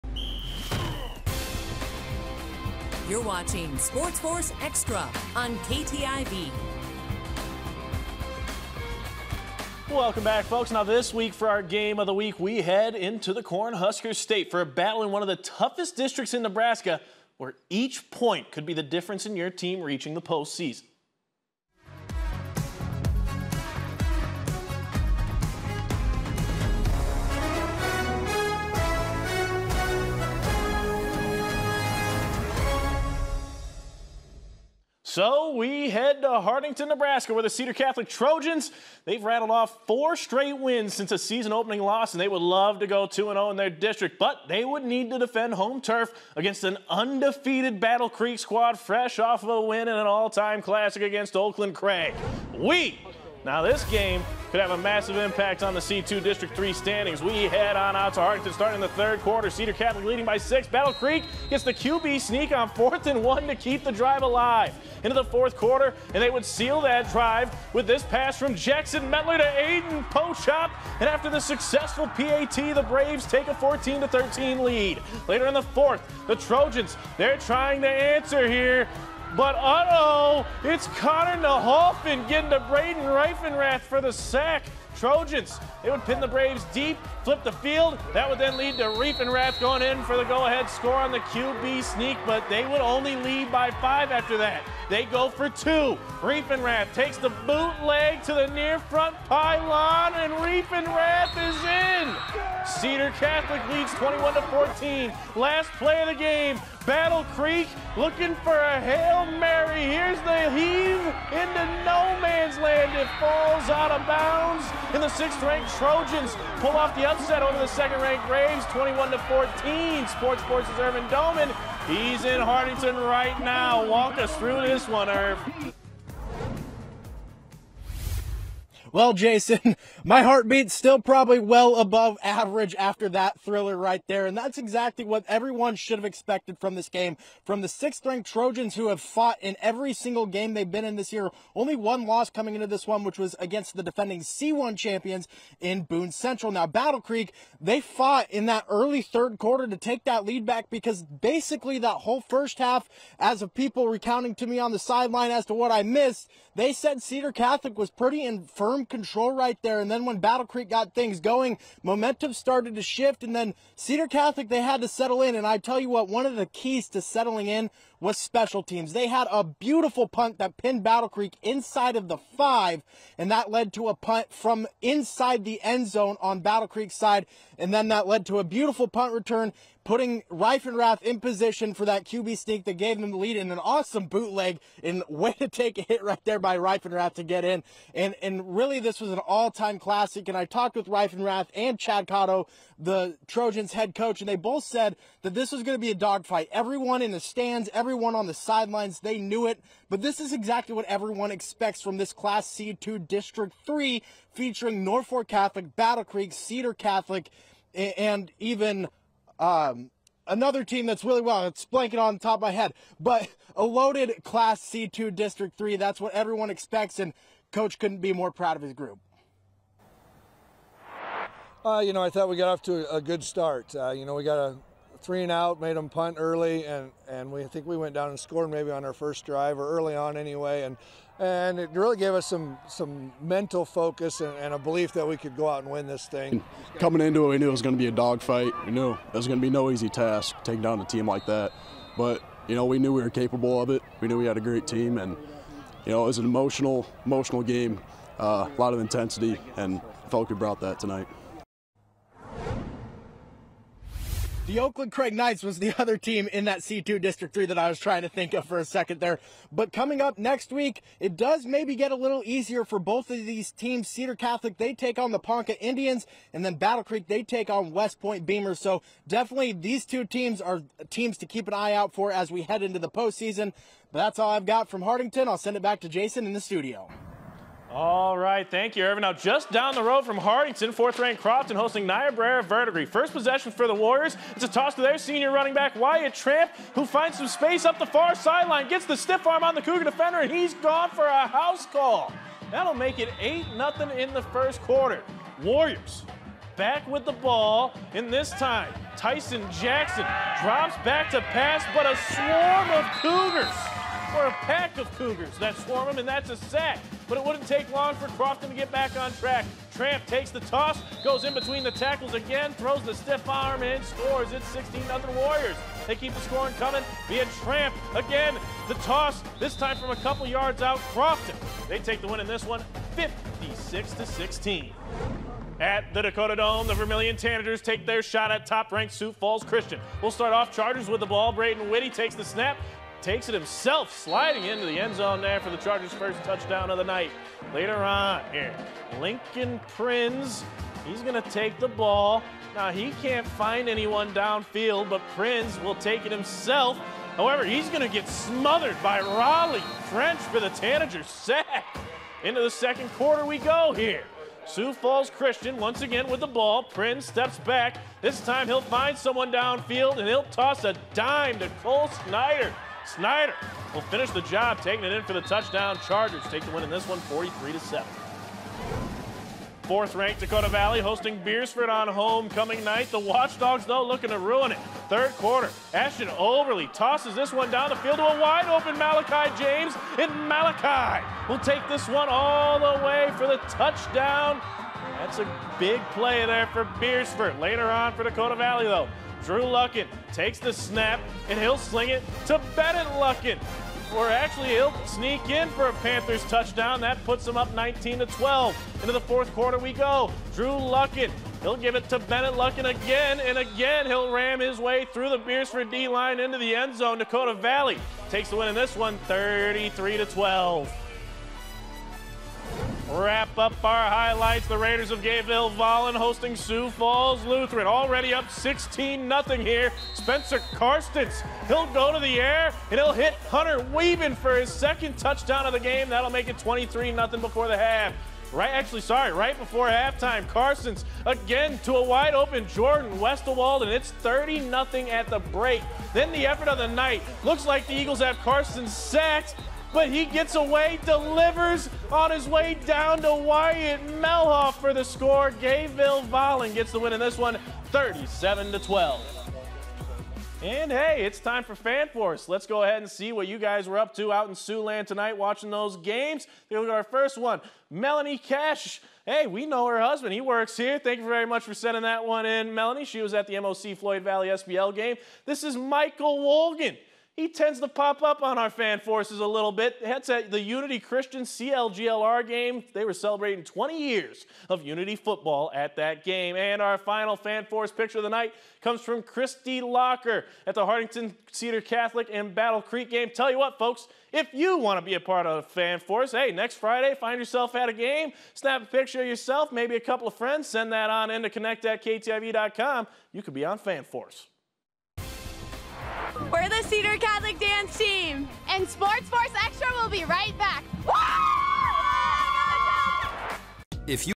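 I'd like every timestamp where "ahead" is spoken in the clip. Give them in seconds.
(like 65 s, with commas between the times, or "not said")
90 s, 452 s.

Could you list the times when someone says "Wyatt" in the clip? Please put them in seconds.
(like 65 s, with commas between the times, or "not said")
285 s, 443 s.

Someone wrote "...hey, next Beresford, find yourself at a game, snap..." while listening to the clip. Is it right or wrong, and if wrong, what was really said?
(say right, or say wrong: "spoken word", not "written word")
wrong: "Friday", not "Beresford".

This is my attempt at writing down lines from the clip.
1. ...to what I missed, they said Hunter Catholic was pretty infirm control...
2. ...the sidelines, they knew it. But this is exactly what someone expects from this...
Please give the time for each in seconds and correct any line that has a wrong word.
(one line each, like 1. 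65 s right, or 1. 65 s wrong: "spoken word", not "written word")
1. 155 s wrong: "Cedar", not "Hunter"
2. 198 s wrong: "everyone", not "someone".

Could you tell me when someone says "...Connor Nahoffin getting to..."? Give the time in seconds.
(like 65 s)
80 s.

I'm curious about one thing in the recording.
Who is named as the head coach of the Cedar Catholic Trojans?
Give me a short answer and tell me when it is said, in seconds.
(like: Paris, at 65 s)
Chad Cotto, at 191 s.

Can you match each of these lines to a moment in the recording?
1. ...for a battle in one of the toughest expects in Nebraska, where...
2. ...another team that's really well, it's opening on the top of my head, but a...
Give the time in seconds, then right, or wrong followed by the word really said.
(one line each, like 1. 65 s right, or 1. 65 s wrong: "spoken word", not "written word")
1. 14 s wrong: "districts", not "expects"
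2. 210 s wrong: "blanking", not "opening".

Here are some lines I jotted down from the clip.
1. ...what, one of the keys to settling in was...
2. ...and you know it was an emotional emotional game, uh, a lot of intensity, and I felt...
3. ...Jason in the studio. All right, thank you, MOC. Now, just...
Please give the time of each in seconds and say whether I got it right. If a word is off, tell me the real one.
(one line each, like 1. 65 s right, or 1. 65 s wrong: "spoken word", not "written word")
1. 165 s right
2. 244 s right
3. 275 s wrong: "Irvin", not "MOC".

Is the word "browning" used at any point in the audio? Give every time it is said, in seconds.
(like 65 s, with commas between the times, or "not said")
not said.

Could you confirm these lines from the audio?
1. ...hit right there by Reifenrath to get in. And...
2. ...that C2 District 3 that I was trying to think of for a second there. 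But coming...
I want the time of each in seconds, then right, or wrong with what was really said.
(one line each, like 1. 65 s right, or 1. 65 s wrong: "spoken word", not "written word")
1. 185 s right
2. 256 s right.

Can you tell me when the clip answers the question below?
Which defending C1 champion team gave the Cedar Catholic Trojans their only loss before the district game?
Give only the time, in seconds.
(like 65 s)
145 s.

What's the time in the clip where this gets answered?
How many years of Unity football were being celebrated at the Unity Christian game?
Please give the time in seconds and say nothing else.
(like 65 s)
473 s.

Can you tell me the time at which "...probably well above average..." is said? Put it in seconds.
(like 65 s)
130 s.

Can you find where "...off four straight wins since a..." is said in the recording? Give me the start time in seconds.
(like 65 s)
39 s.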